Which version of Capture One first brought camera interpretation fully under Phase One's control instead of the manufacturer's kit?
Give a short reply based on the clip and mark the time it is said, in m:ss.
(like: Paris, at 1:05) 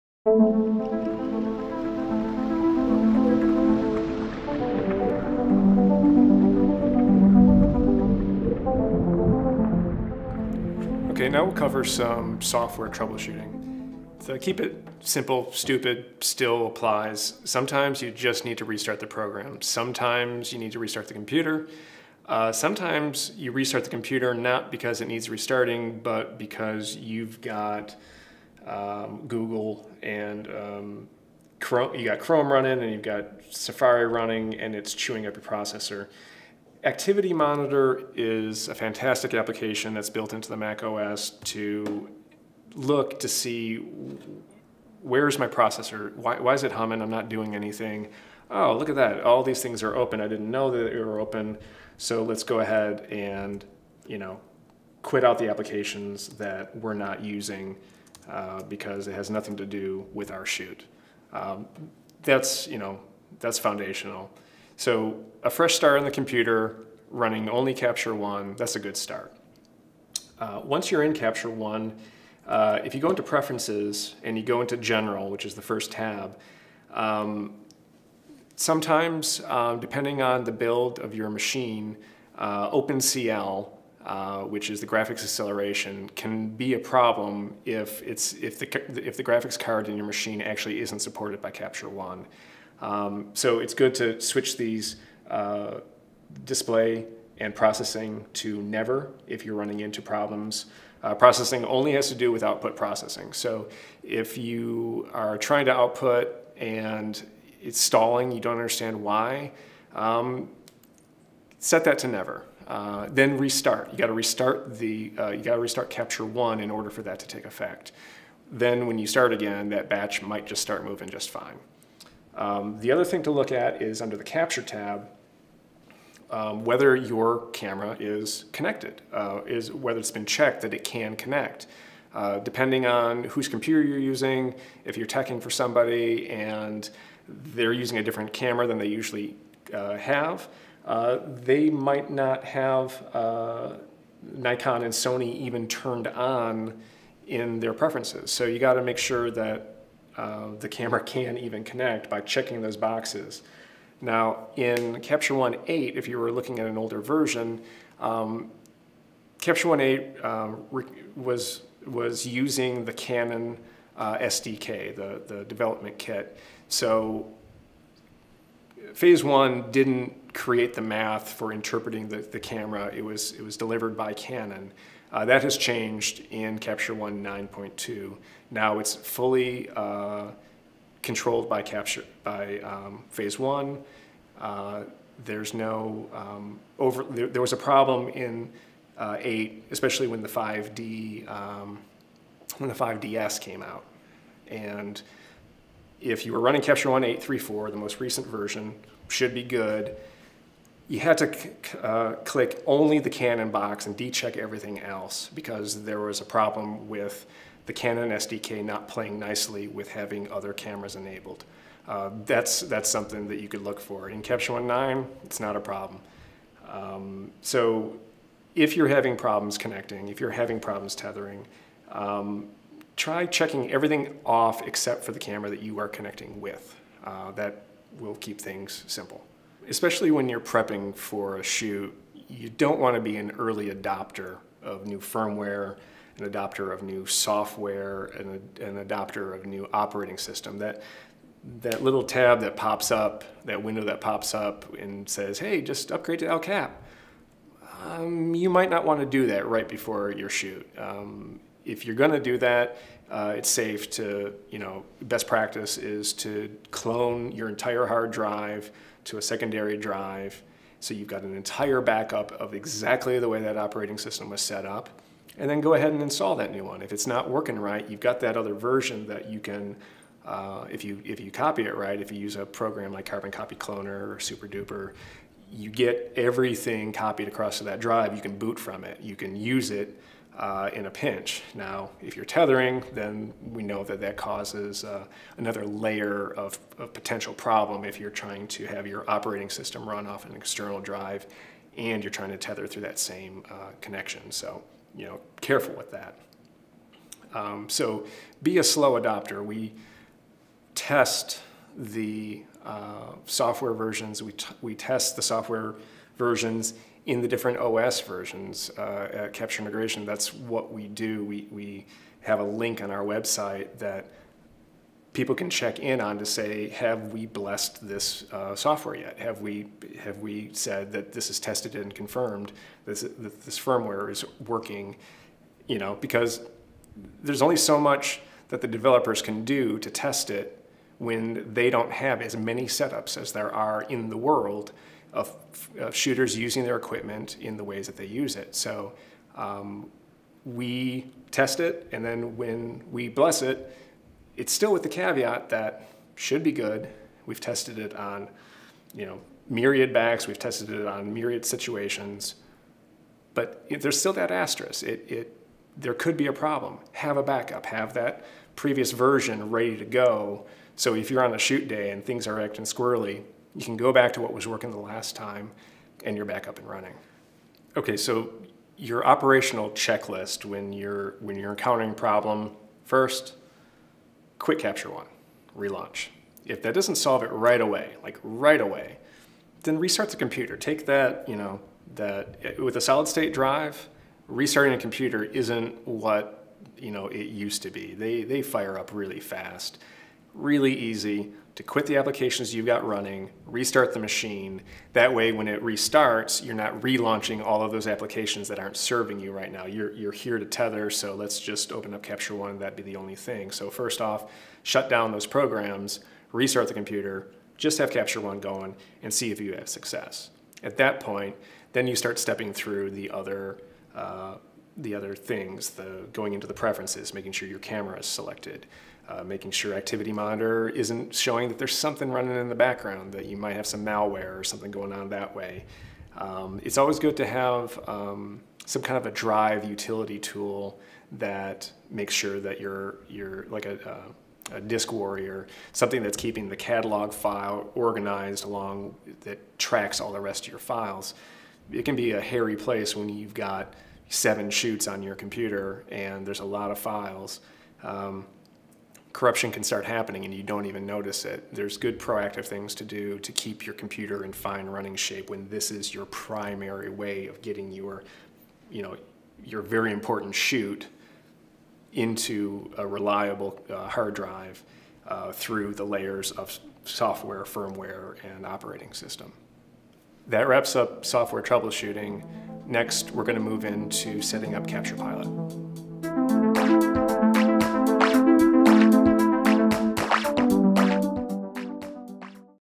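9.2, at 2:56.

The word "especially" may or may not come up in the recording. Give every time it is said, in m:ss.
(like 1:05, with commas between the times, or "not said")
3:09, 3:49.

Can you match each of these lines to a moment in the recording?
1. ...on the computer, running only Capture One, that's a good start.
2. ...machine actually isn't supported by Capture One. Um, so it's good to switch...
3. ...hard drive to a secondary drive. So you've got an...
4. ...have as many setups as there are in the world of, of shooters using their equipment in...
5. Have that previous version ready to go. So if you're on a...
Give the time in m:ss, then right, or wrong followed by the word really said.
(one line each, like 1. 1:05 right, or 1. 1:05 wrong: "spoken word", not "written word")
1. 1:05 right
2. 1:30 right
3. 4:17 right
4. 5:31 right
5. 5:57 right.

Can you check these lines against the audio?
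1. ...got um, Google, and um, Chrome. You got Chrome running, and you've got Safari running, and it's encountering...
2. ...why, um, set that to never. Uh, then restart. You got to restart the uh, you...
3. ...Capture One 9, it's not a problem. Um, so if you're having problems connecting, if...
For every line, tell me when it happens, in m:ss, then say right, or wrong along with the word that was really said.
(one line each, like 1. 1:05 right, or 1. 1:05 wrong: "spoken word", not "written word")
1. 0:27 wrong: "chewing", not "encountering"
2. 1:48 right
3. 3:34 right.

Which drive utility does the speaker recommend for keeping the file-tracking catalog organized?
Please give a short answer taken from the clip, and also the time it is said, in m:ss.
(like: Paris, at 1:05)
DiskWarrior, at 7:14.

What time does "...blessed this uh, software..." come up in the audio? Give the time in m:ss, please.
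5:17.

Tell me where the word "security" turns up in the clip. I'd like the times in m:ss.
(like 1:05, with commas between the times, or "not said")
not said.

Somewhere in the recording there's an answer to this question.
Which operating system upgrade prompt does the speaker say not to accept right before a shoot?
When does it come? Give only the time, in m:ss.
4:06.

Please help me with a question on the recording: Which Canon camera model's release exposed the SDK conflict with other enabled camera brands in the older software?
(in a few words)
5DS.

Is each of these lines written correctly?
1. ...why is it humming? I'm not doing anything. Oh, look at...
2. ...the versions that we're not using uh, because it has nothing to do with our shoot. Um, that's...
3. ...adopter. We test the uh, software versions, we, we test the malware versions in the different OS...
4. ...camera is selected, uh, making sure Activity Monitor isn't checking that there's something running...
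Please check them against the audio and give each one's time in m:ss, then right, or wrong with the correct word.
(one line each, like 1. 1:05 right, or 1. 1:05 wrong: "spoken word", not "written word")
1. 0:46 right
2. 0:55 wrong: "applications", not "versions"
3. 4:58 wrong: "software", not "malware"
4. 6:57 wrong: "showing", not "checking".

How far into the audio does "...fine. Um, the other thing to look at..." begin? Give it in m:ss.
2:01.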